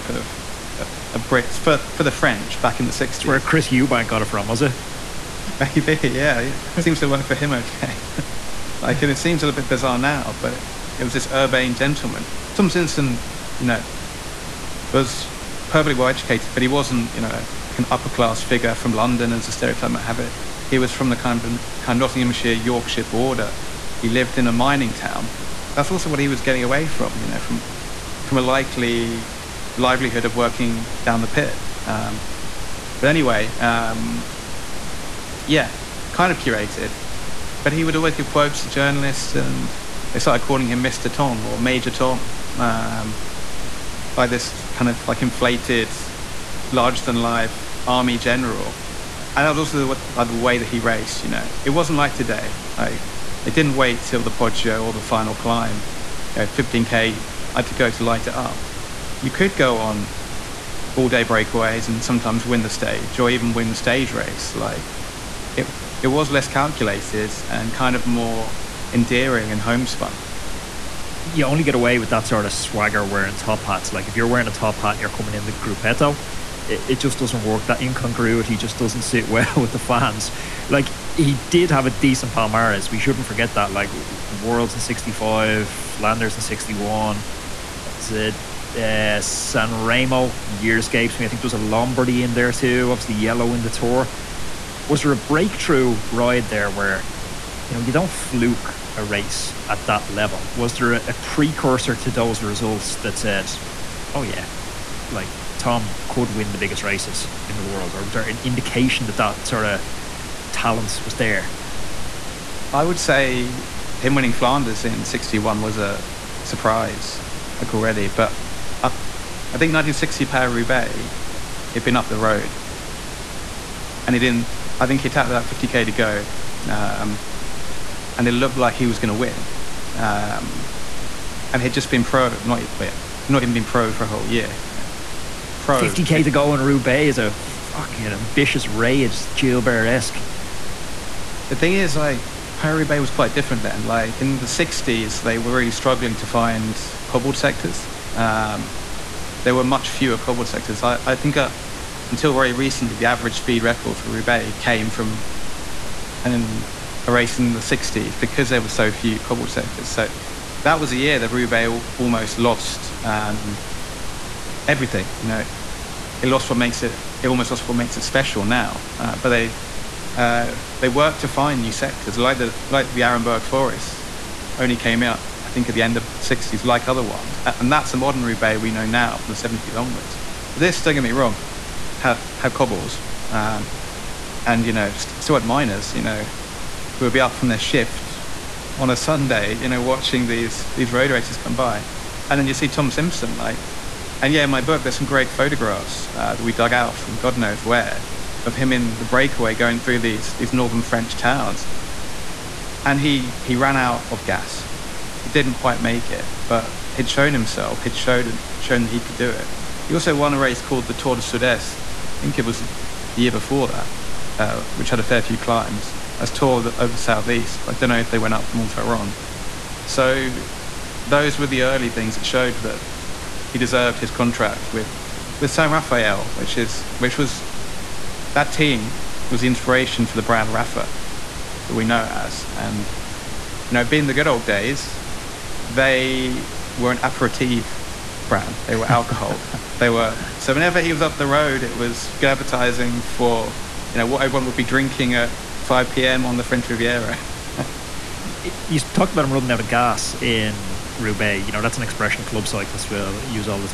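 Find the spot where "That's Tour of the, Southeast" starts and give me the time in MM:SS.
03:36.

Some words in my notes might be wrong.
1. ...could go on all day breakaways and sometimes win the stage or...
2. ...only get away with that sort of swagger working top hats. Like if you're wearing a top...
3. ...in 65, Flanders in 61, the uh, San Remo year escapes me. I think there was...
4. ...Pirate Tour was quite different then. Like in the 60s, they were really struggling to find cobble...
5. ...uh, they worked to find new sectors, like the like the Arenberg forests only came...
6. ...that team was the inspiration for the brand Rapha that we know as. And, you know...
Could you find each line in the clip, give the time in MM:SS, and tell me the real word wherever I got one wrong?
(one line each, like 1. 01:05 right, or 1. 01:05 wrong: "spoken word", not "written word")
1. 00:59 right
2. 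01:11 wrong: "wearing", not "working"
3. 01:24 right
4. 02:22 wrong: "Bay", not "Tour"
5. 02:50 right
6. 03:48 right.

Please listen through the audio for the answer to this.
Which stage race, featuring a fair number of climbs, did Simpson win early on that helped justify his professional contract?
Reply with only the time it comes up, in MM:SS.
03:30.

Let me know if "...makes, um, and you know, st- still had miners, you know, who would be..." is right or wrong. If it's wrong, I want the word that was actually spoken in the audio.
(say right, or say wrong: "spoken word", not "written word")
wrong: "cobbles", not "makes".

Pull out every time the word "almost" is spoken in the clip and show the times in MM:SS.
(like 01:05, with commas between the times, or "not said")
02:41, 02:47.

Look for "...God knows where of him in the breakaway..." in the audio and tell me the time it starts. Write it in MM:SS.
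03:17.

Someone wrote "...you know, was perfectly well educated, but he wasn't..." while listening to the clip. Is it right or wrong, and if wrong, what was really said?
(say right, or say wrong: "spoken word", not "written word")
right.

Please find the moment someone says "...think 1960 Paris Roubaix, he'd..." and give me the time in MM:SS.
01:59.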